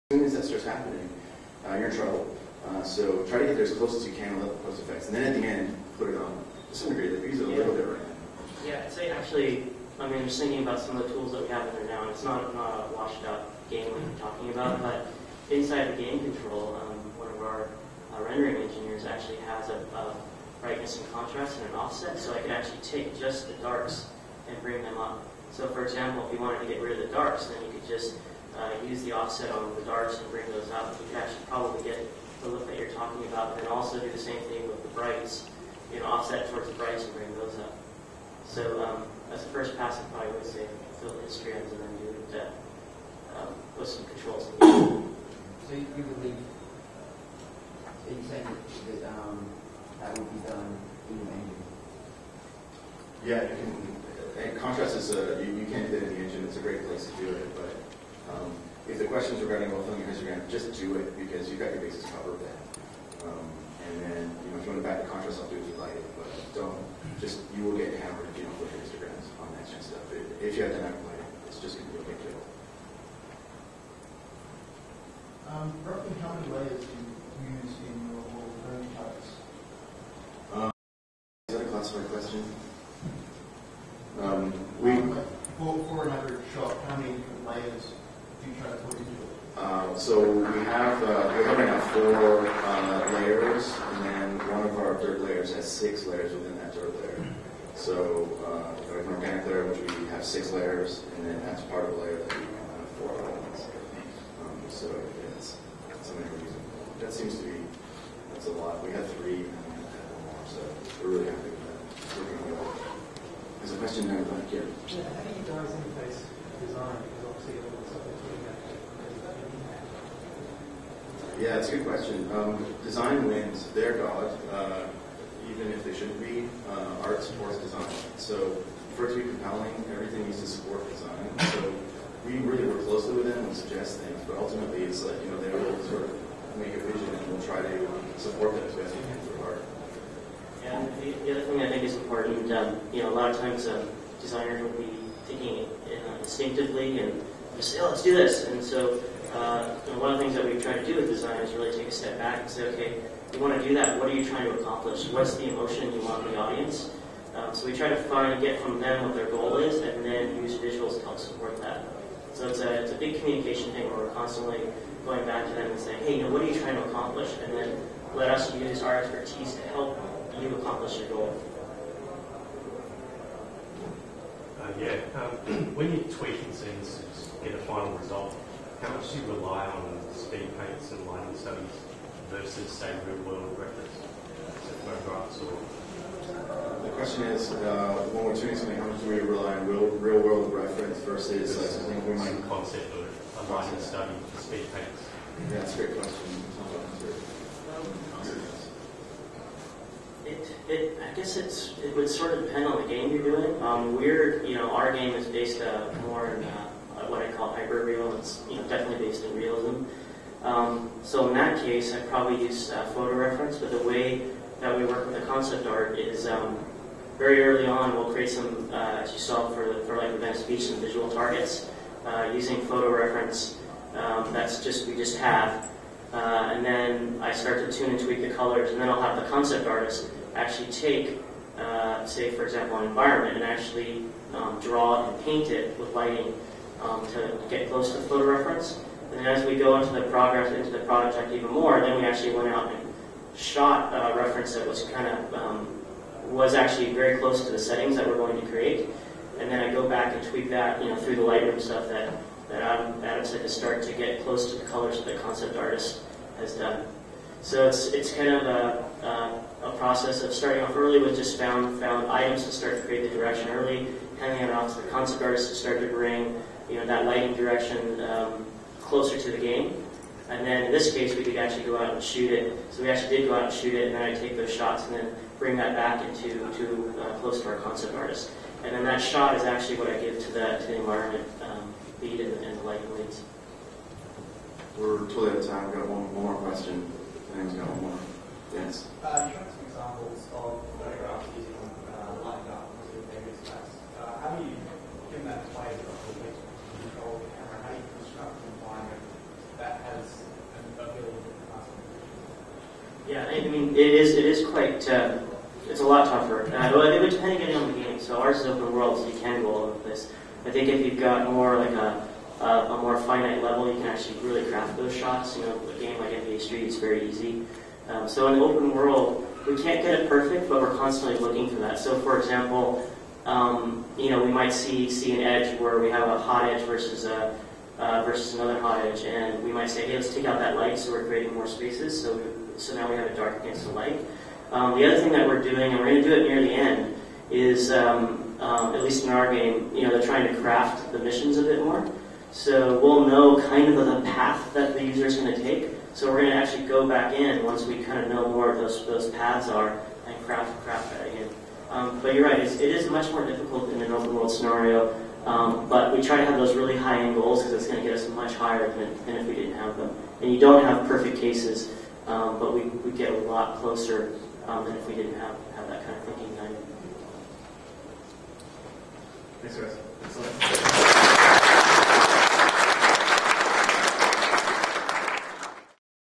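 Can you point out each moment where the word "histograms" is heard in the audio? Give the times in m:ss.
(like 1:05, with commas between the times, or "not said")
0:41, 1:00, 1:08.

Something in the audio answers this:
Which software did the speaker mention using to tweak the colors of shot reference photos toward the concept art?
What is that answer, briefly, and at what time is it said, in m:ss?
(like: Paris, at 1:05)
Lightroom, at 4:11.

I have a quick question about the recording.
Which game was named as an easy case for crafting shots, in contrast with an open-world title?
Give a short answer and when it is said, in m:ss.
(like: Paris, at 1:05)
NBA Street, at 5:16.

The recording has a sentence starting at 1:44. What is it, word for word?
Um, so yeah, that's something we're using.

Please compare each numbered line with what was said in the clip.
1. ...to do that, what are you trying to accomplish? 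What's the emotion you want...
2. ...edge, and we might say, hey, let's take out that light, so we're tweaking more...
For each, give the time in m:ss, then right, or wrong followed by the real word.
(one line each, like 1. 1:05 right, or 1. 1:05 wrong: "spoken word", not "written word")
1. 2:33 right
2. 5:28 wrong: "creating", not "tweaking".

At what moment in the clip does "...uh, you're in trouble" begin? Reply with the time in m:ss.
0:01.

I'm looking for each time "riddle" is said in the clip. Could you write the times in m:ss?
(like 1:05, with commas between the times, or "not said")
not said.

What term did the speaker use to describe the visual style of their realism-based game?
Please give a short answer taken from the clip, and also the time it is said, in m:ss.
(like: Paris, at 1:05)
Hyperreal, at 3:27.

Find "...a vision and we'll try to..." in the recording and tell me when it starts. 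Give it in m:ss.
2:16.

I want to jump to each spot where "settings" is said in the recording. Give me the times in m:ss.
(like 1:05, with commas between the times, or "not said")
4:07.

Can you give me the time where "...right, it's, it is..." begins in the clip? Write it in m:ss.
5:52.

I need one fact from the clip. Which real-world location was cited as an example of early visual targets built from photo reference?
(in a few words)
Venice Beach.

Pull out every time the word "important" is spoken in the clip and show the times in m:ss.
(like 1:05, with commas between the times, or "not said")
2:21.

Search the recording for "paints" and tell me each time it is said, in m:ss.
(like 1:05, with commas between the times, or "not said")
3:00, 3:14, 3:55.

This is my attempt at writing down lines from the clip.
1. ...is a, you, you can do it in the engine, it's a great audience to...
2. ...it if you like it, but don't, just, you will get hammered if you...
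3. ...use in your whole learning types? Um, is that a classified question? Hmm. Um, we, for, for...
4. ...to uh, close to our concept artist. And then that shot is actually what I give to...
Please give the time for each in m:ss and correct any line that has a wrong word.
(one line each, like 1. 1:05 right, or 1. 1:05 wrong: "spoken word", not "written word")
1. 0:54 wrong: "place", not "audience"
2. 1:05 right
3. 1:17 right
4. 4:36 right.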